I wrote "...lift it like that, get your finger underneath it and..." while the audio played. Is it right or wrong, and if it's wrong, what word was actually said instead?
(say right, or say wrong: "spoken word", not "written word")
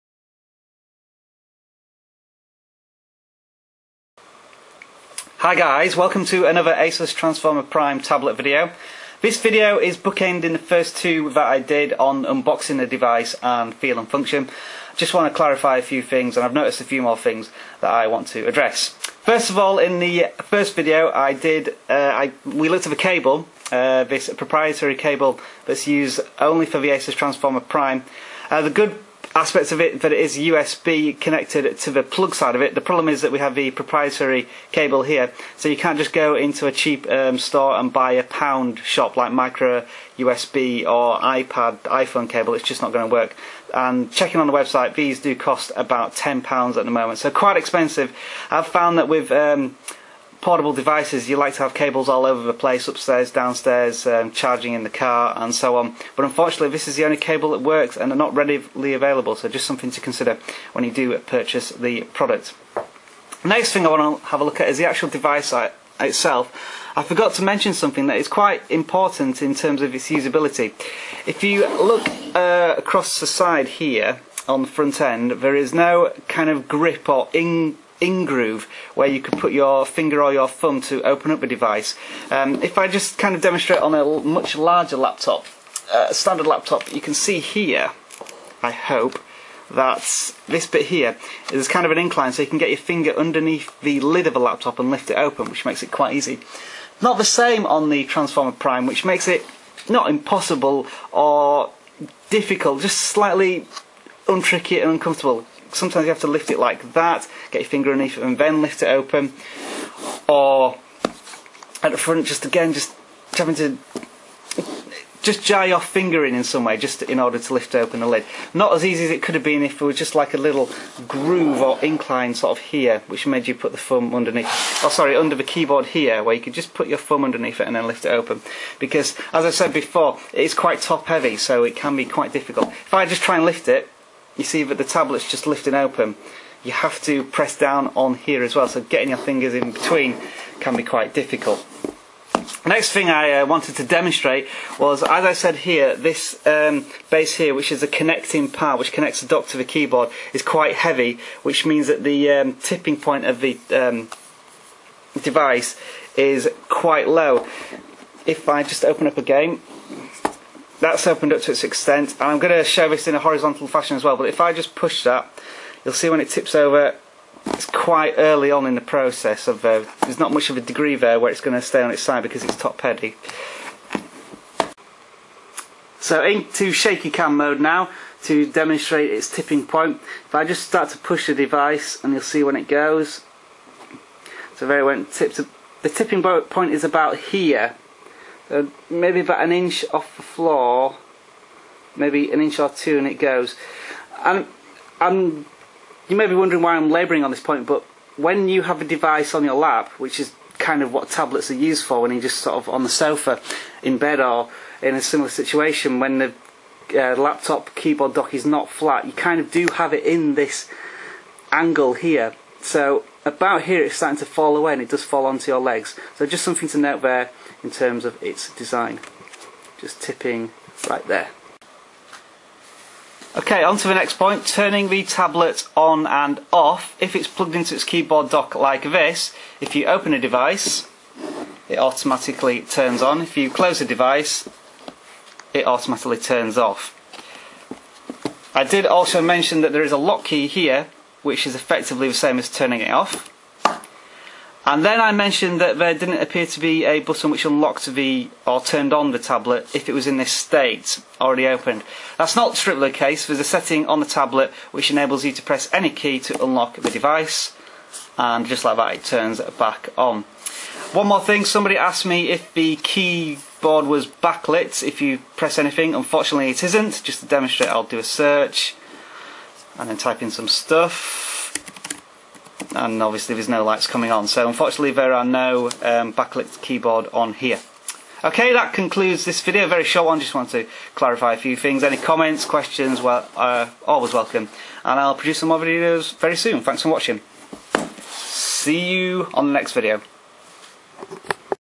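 right.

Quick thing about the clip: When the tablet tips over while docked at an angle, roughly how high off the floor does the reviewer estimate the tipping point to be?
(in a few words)
an inch or two.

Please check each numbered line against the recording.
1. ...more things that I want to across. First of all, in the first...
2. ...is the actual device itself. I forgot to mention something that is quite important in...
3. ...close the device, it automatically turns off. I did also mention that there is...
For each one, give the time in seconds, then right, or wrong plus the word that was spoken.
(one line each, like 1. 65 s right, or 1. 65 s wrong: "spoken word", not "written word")
1. 17 s wrong: "address", not "across"
2. 64 s right
3. 233 s right.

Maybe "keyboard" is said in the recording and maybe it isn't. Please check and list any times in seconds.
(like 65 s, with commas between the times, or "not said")
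125 s, 149 s, 207 s, 227 s, 262 s, 276 s.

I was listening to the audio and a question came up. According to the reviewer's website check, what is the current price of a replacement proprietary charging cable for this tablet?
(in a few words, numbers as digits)
£10.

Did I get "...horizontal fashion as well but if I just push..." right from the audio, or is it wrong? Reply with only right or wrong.
right.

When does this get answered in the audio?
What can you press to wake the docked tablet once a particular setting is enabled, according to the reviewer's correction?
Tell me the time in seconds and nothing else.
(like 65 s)
255 s.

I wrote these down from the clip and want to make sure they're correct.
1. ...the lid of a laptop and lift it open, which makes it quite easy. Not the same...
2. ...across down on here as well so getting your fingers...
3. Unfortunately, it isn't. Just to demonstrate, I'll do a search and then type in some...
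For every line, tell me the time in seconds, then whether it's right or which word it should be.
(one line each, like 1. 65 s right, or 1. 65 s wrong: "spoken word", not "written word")
1. 93 s right
2. 137 s wrong: "press", not "across"
3. 265 s right.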